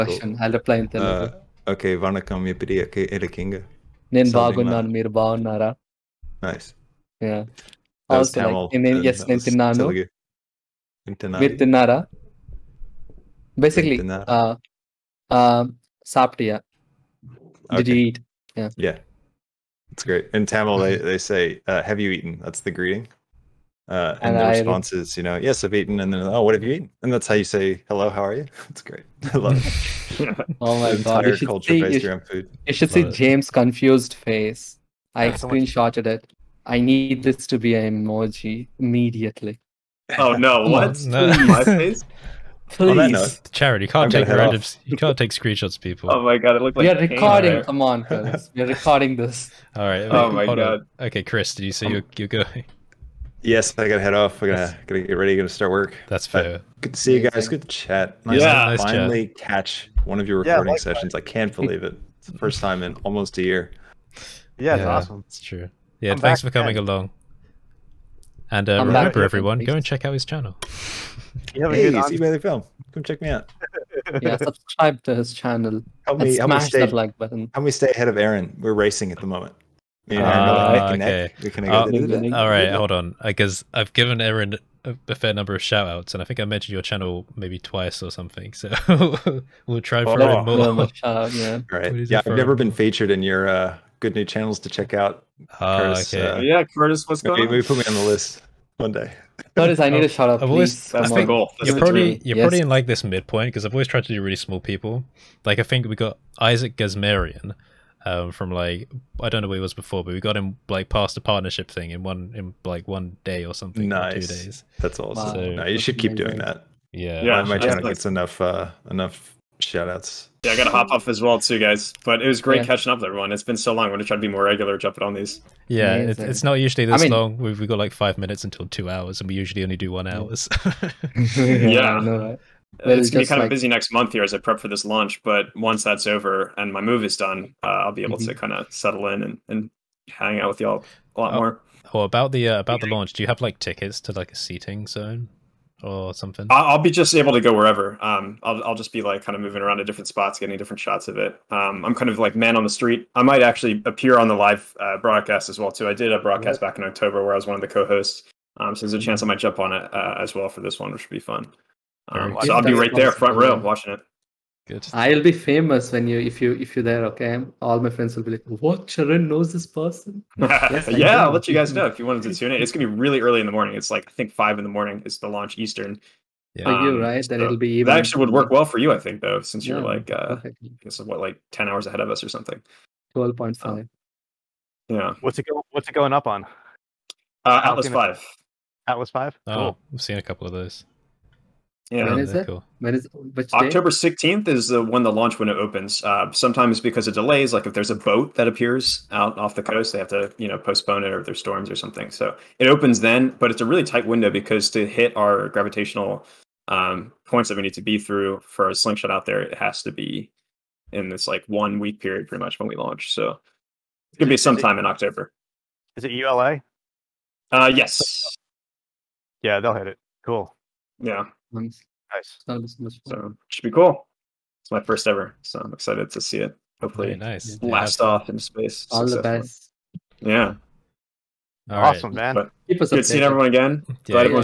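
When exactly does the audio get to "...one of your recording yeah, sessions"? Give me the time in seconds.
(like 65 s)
60 s.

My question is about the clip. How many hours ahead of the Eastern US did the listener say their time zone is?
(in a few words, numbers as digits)
12.5.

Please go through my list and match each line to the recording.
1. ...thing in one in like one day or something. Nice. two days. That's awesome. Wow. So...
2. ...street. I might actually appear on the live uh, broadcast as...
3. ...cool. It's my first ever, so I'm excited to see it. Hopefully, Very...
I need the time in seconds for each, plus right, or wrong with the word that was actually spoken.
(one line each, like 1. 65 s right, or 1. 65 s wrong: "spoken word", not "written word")
1. 111 s right
2. 152 s right
3. 223 s right.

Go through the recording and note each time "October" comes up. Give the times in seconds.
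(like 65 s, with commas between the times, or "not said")
156 s, 193 s, 214 s.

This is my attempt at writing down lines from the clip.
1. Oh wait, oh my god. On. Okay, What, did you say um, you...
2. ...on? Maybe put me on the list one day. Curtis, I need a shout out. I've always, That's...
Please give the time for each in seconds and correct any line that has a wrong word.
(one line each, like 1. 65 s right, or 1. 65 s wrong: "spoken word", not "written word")
1. 50 s wrong: "Chris", not "What"
2. 97 s right.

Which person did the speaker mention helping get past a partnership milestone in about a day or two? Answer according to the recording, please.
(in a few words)
Isaac Gazmarian.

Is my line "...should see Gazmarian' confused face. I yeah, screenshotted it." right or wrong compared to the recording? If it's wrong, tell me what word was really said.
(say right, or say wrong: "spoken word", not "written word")
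wrong: "James", not "Gazmarian".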